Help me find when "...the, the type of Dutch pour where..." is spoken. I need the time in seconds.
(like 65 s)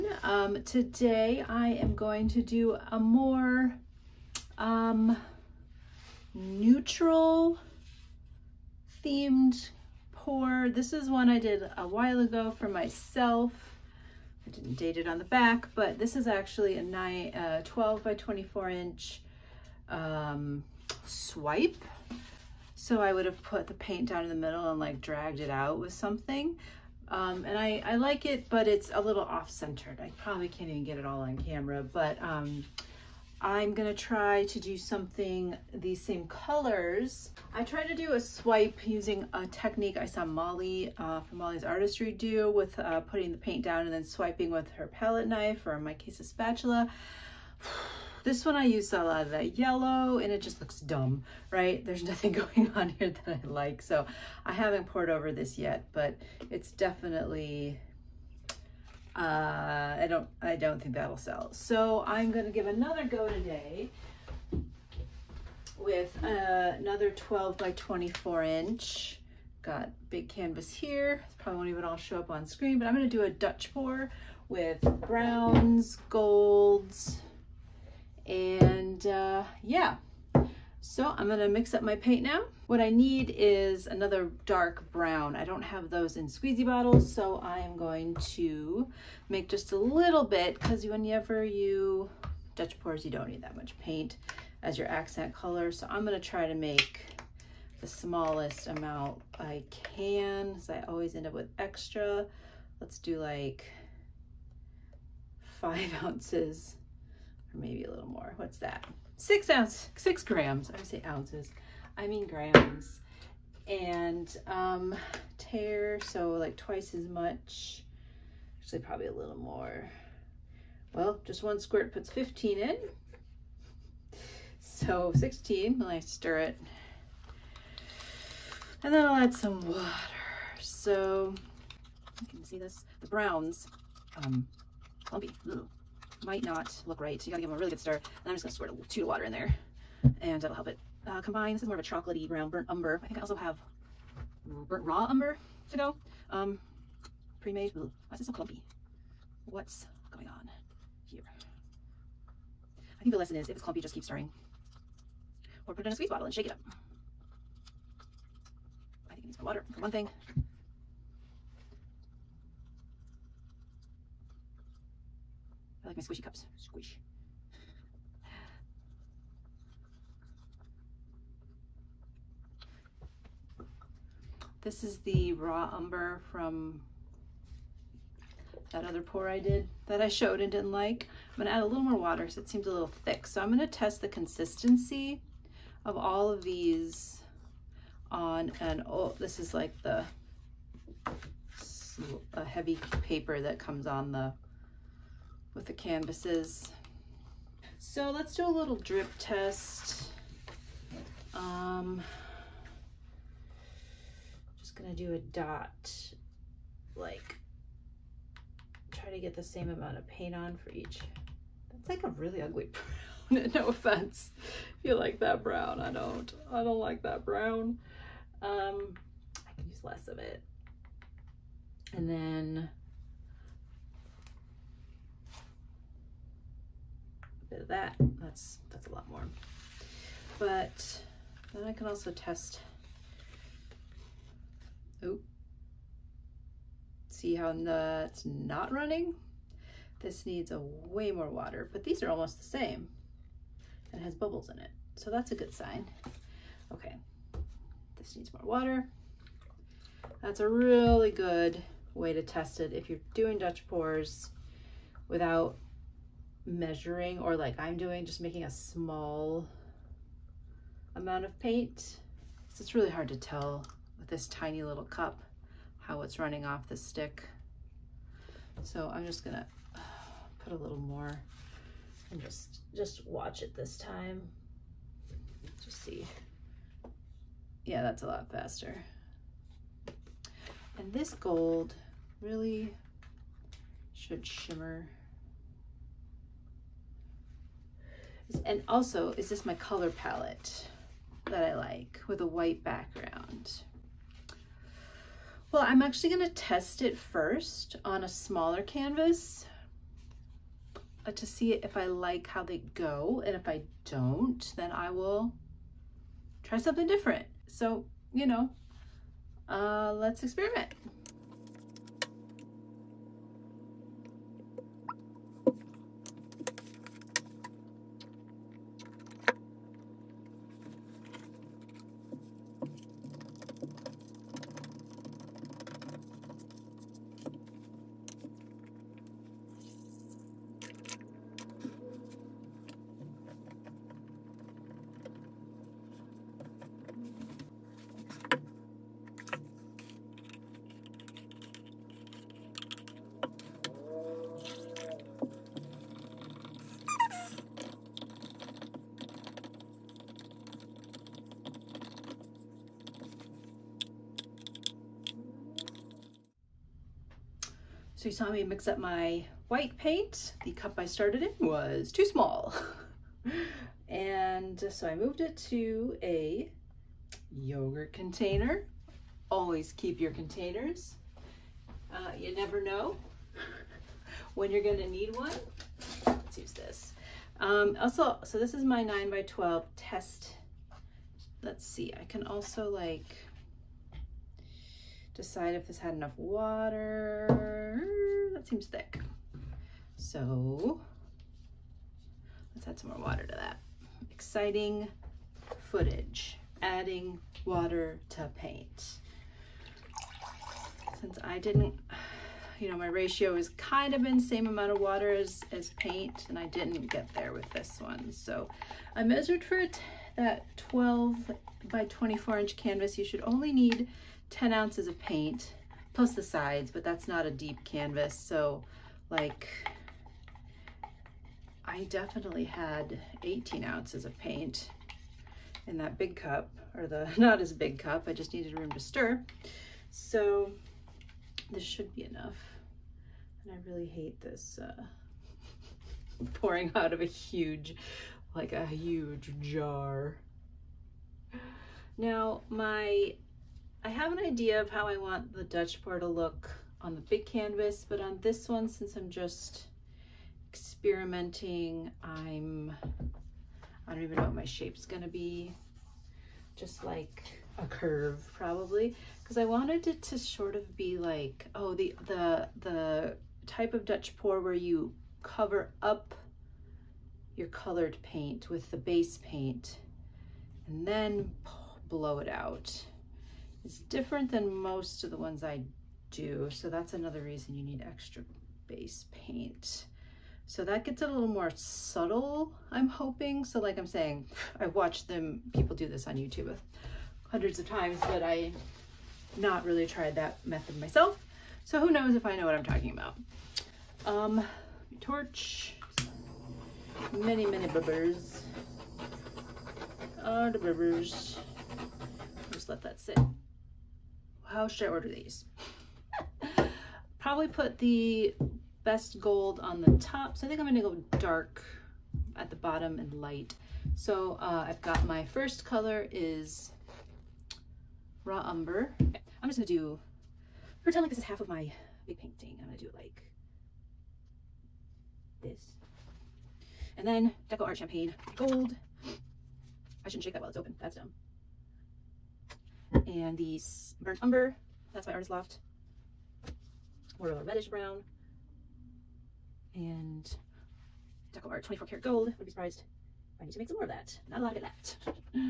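462 s.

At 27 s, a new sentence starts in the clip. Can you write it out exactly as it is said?
Um, and I, I like it, but it's a little off-centered.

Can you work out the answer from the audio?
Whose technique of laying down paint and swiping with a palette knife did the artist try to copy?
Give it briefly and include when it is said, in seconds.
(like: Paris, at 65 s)
Molly's Artistry, at 41 s.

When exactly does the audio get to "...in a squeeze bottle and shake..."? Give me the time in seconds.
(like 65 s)
155 s.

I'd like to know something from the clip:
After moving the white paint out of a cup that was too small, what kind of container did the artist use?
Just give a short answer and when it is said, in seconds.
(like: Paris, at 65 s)
yogurt container, at 367 s.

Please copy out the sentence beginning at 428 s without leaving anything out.
I just needed room to stir.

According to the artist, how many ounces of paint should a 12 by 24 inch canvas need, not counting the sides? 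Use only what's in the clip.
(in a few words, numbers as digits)
10 ounces.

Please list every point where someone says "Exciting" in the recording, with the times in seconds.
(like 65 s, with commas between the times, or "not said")
394 s.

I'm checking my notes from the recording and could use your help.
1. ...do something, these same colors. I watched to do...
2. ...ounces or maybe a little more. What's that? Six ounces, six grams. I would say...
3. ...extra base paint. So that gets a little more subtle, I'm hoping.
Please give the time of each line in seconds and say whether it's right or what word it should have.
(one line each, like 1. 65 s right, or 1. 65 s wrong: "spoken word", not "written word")
1. 34 s wrong: "tried", not "watched"
2. 106 s right
3. 477 s right.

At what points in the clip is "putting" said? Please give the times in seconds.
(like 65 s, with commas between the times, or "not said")
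42 s.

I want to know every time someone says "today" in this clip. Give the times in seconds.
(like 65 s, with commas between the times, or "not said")
0 s, 63 s.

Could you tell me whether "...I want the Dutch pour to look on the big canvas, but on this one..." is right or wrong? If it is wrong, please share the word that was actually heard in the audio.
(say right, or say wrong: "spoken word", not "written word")
right.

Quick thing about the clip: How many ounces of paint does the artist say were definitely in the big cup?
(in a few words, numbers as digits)
18 ounces.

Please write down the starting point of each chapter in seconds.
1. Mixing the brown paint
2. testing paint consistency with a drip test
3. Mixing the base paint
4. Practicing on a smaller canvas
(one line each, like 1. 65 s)
1. 82 s
2. 172 s
3. 310 s
4. 355 s.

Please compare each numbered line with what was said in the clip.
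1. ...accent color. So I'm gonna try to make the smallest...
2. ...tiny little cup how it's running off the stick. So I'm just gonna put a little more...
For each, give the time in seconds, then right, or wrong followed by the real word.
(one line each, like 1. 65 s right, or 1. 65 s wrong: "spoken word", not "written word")
1. 94 s right
2. 264 s right.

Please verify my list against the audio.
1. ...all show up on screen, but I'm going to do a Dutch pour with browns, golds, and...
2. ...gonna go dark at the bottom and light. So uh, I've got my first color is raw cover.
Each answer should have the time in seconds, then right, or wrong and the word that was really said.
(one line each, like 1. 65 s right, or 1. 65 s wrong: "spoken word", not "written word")
1. 71 s right
2. 510 s wrong: "umber", not "cover".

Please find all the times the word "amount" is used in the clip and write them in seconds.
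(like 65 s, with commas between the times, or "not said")
98 s, 209 s, 260 s, 404 s.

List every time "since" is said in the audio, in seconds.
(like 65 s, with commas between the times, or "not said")
400 s, 448 s.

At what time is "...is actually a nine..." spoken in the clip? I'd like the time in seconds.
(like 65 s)
16 s.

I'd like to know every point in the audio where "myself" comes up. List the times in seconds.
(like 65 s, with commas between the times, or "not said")
12 s, 490 s.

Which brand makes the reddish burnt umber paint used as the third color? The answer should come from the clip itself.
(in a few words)
Artist Loft.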